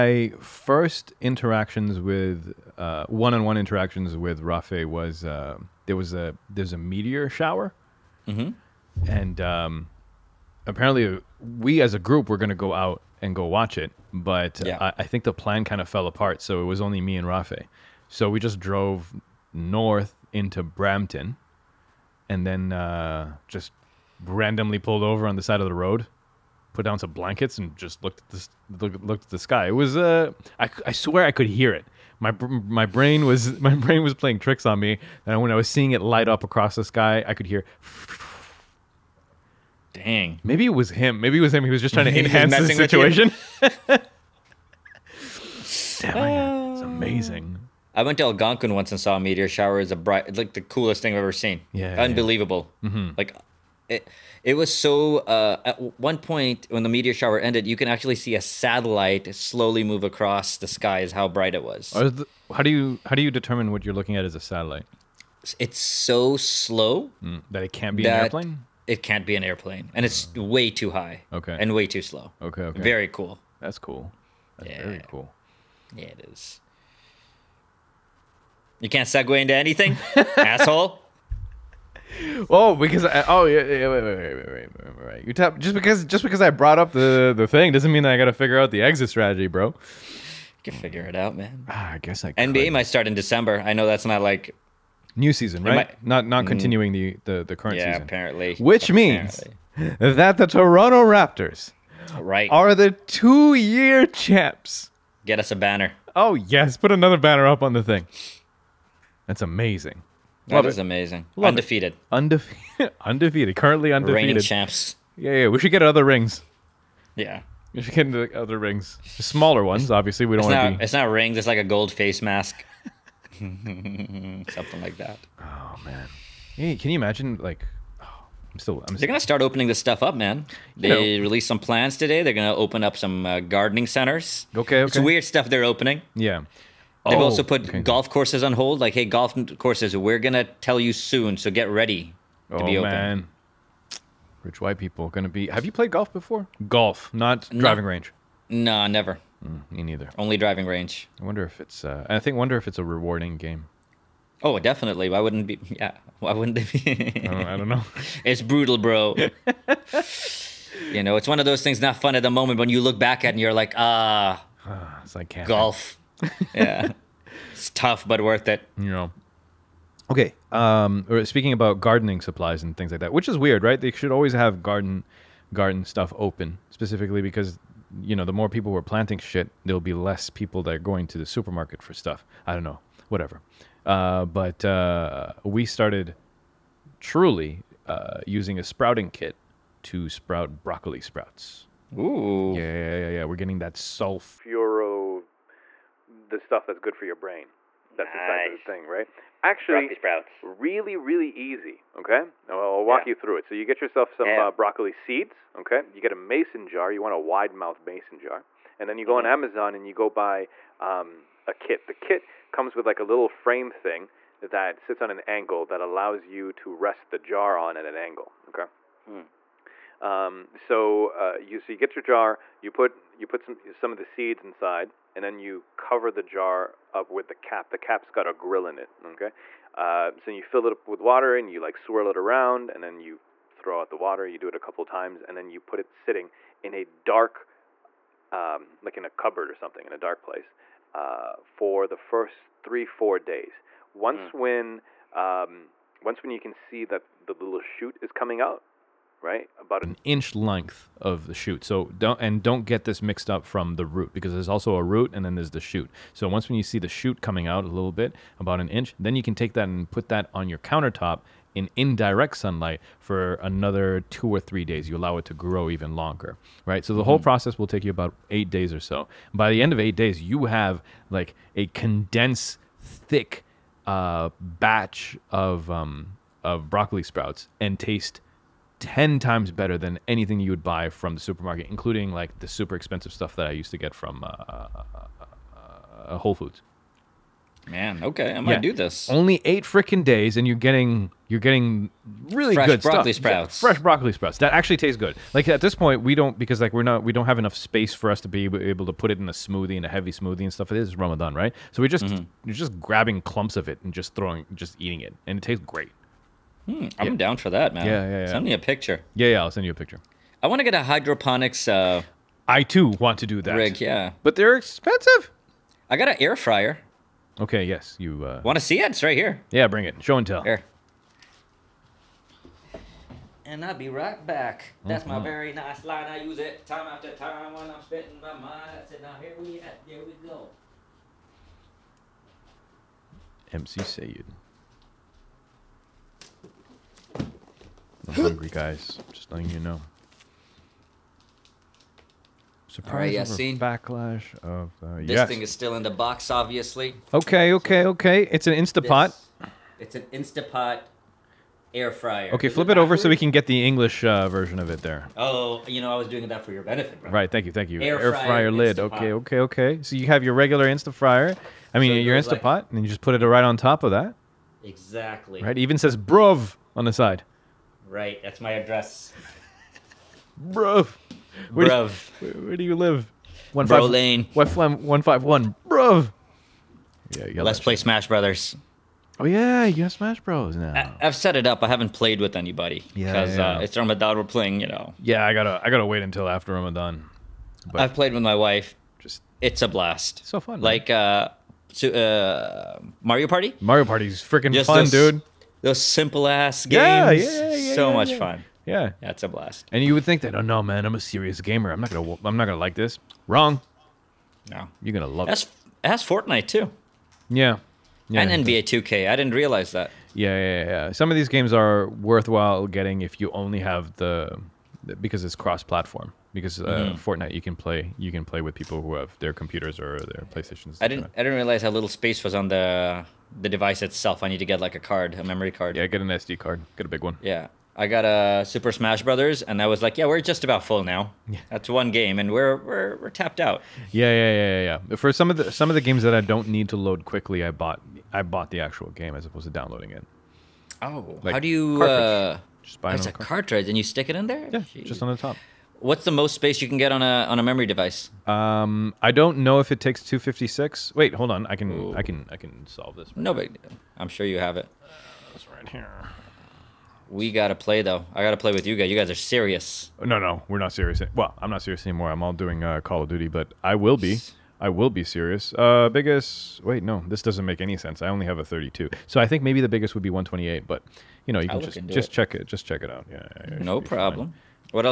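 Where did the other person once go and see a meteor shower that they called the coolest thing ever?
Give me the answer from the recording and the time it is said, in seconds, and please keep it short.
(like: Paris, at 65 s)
Algonquin, at 48 s.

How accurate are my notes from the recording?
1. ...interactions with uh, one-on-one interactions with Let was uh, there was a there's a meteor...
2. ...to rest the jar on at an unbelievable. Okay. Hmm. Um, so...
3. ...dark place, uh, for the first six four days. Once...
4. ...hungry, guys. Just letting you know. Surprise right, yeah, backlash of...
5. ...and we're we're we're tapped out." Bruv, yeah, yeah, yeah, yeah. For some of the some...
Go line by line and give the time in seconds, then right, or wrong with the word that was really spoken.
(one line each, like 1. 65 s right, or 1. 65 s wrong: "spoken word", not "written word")
1. 1 s wrong: "Rafe", not "Let"
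2. 216 s wrong: "angle", not "unbelievable"
3. 239 s wrong: "three", not "six"
4. 338 s right
5. 432 s wrong: "Yeah", not "Bruv".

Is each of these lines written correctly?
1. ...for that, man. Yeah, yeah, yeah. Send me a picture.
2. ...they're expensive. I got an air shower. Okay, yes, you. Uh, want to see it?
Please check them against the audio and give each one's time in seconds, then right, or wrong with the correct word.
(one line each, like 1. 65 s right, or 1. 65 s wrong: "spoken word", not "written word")
1. 307 s right
2. 314 s wrong: "fryer", not "shower".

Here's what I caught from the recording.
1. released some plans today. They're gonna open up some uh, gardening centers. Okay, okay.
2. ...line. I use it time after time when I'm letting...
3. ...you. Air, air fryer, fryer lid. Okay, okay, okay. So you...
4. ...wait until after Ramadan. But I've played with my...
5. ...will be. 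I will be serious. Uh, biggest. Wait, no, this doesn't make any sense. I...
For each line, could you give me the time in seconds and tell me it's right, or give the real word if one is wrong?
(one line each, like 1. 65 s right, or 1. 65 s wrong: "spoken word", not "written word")
1. 131 s right
2. 325 s wrong: "spitting", not "letting"
3. 357 s right
4. 385 s right
5. 463 s right.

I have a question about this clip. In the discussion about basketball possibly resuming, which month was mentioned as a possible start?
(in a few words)
December.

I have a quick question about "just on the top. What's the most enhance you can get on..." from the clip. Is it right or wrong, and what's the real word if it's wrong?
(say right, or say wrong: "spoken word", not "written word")
wrong: "space", not "enhance".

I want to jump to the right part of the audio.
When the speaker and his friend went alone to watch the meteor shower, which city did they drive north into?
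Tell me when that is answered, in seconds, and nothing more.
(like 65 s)
20 s.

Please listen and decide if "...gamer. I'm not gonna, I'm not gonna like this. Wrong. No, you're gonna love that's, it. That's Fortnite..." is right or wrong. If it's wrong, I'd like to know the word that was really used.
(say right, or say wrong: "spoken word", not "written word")
right.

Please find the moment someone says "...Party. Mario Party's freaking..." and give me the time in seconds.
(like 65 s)
393 s.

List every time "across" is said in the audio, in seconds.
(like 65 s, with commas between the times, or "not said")
36 s, 60 s.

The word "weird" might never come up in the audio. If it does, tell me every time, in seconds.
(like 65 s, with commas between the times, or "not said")
134 s, 173 s.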